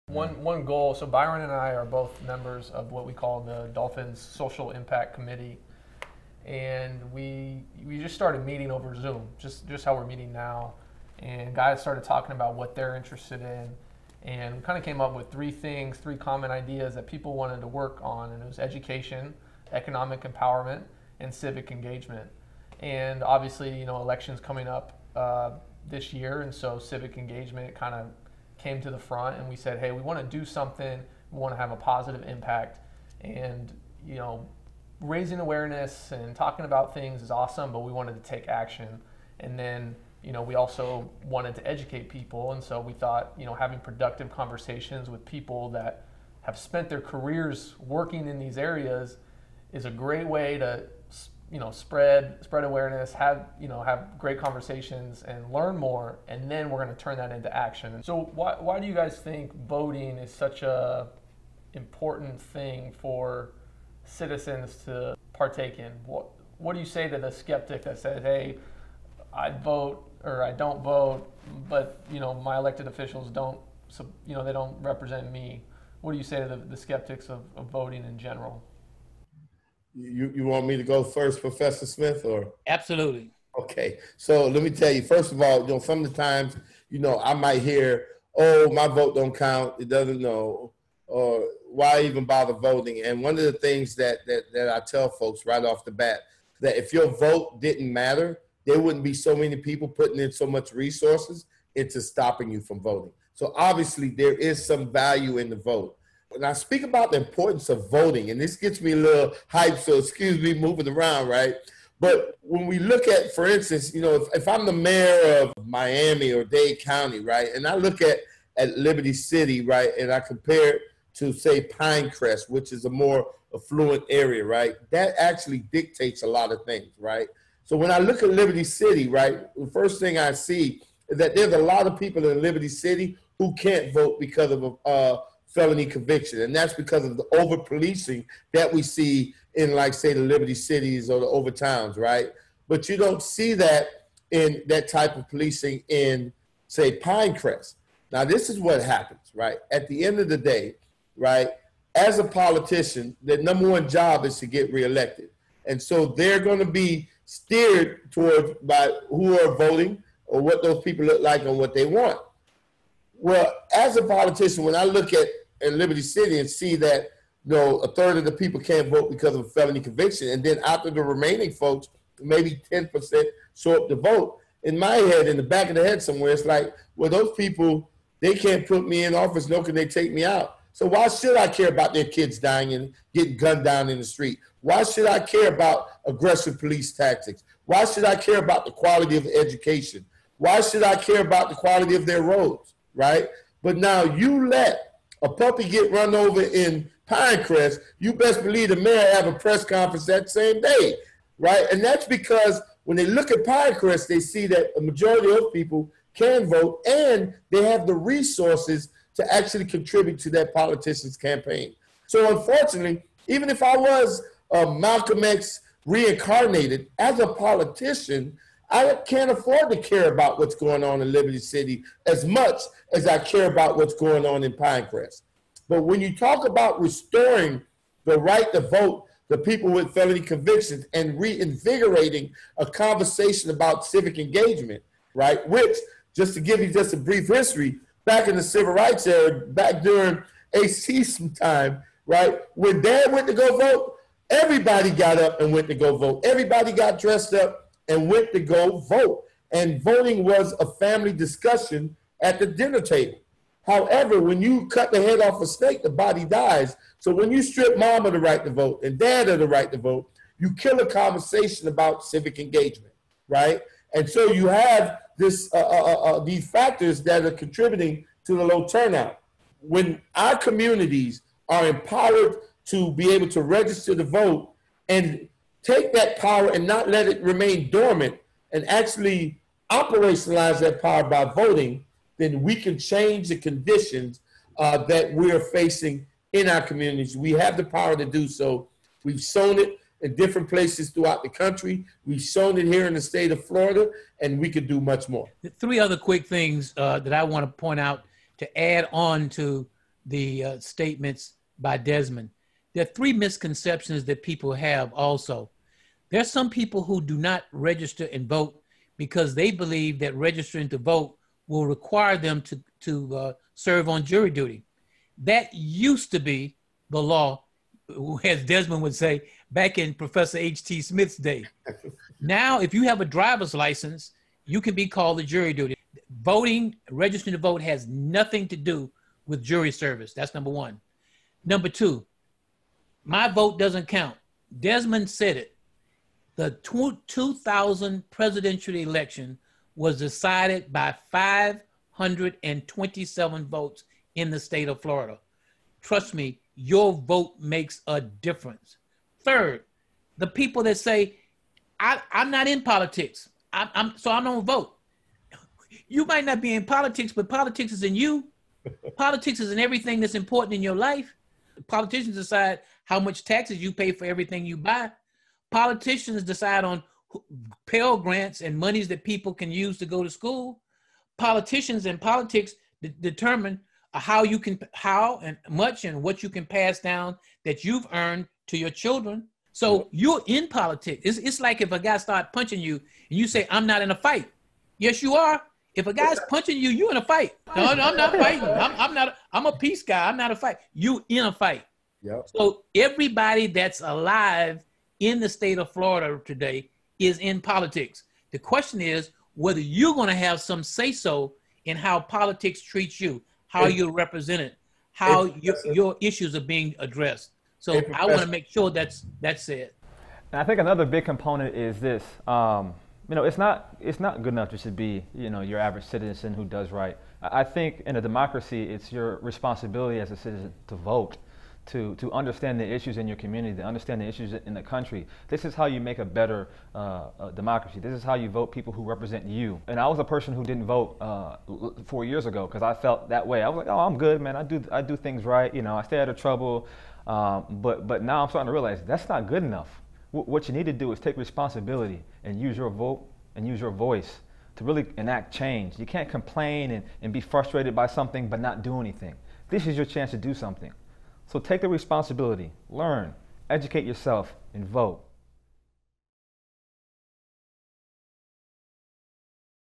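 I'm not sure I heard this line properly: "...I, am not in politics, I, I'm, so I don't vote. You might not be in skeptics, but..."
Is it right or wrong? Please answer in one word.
wrong.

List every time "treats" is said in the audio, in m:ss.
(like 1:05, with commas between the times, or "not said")
6:42.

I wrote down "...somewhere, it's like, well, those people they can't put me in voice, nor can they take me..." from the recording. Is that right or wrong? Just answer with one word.
wrong.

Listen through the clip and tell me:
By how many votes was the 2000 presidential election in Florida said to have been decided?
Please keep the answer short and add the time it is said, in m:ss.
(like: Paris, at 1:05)
527, at 5:41.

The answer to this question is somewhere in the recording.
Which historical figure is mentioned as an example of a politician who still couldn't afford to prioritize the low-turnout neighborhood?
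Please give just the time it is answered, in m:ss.
3:34.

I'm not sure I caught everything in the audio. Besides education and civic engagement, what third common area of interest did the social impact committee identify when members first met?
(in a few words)
economic empowerment.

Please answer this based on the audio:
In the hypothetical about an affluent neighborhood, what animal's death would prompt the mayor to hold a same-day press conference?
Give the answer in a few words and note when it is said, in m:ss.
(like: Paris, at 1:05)
a puppy, at 3:15.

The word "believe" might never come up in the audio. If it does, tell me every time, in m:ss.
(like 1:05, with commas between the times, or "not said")
3:18, 5:09.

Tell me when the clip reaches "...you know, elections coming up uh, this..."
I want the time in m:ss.
0:23.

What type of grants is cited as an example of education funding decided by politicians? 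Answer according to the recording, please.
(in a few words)
Pell grants.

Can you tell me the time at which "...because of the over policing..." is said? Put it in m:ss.
2:16.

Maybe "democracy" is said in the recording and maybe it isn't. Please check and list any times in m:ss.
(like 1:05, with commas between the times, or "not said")
6:58, 7:07.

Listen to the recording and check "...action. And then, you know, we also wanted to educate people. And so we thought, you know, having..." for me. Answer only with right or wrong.
right.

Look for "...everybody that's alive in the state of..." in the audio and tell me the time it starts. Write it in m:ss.
6:32.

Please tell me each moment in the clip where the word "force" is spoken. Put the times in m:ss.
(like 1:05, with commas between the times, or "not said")
not said.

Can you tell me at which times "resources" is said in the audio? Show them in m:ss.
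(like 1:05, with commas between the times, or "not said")
1:40, 3:27.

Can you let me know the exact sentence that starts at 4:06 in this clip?
Everybody got dressed up and went to go vote.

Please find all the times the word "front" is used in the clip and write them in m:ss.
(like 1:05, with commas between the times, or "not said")
0:28.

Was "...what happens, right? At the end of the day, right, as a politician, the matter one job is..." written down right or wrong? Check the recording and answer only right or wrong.
wrong.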